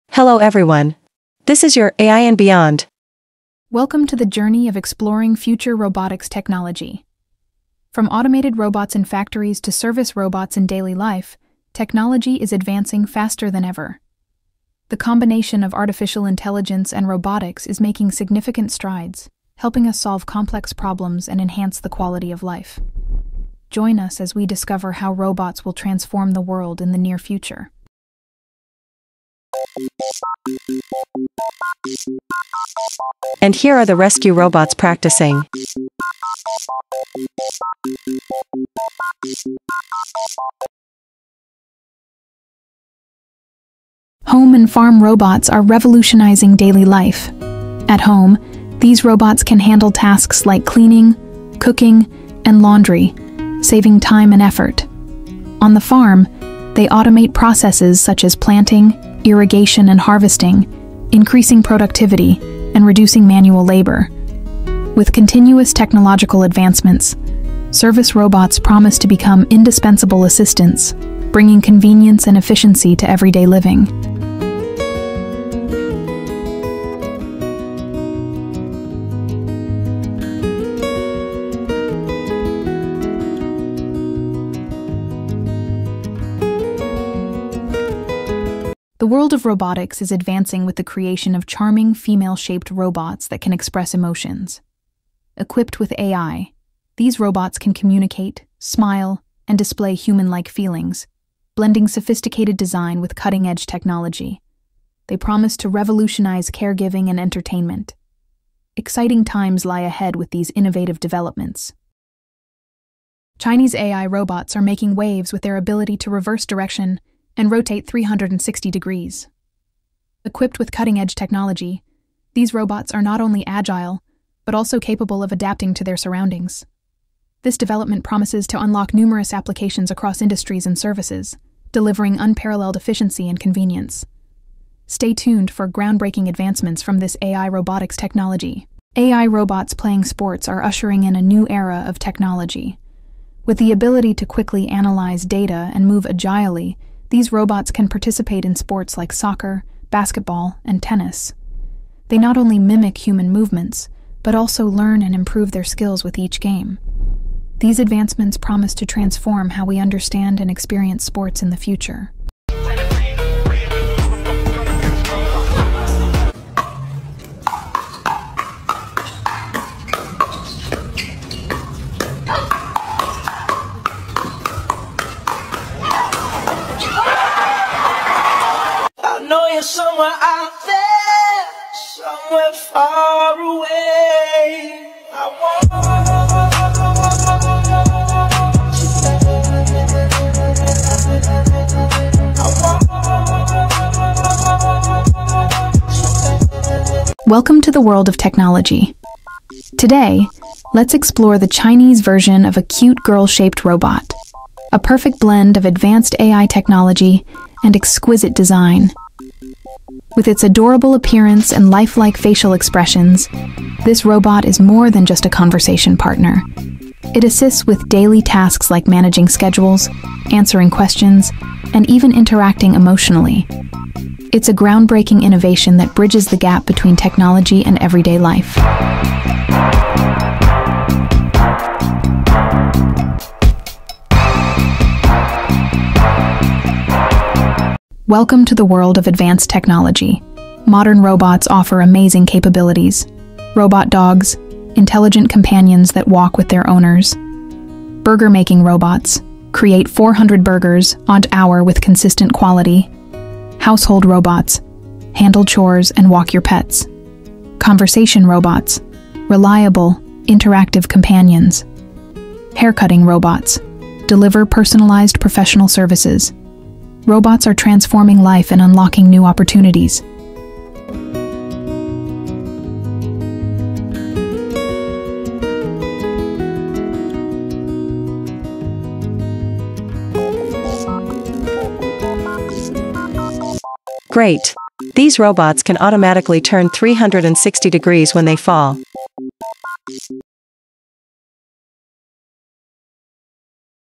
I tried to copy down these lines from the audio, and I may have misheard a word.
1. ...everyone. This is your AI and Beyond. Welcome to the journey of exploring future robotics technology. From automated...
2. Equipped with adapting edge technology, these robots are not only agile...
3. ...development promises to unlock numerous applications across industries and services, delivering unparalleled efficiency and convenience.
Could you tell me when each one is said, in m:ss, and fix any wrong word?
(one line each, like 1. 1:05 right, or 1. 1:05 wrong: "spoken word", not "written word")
1. 0:00 right
2. 2:00 wrong: "cutting", not "adapting"
3. 2:07 right.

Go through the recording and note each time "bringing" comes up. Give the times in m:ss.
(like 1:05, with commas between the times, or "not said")
1:11.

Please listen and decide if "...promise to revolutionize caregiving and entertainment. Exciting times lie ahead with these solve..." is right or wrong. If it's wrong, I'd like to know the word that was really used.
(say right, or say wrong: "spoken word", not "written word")
wrong: "innovative", not "solve".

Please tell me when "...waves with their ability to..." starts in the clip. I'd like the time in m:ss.
1:54.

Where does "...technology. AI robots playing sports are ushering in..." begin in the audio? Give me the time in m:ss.
2:17.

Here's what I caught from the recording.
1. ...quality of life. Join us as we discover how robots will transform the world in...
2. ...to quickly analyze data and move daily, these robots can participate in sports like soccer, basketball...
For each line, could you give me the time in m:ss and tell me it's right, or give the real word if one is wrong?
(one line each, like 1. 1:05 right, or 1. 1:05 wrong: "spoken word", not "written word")
1. 0:21 right
2. 2:24 wrong: "agilely", not "daily".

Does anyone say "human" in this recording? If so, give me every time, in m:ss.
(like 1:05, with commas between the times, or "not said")
1:39, 2:33.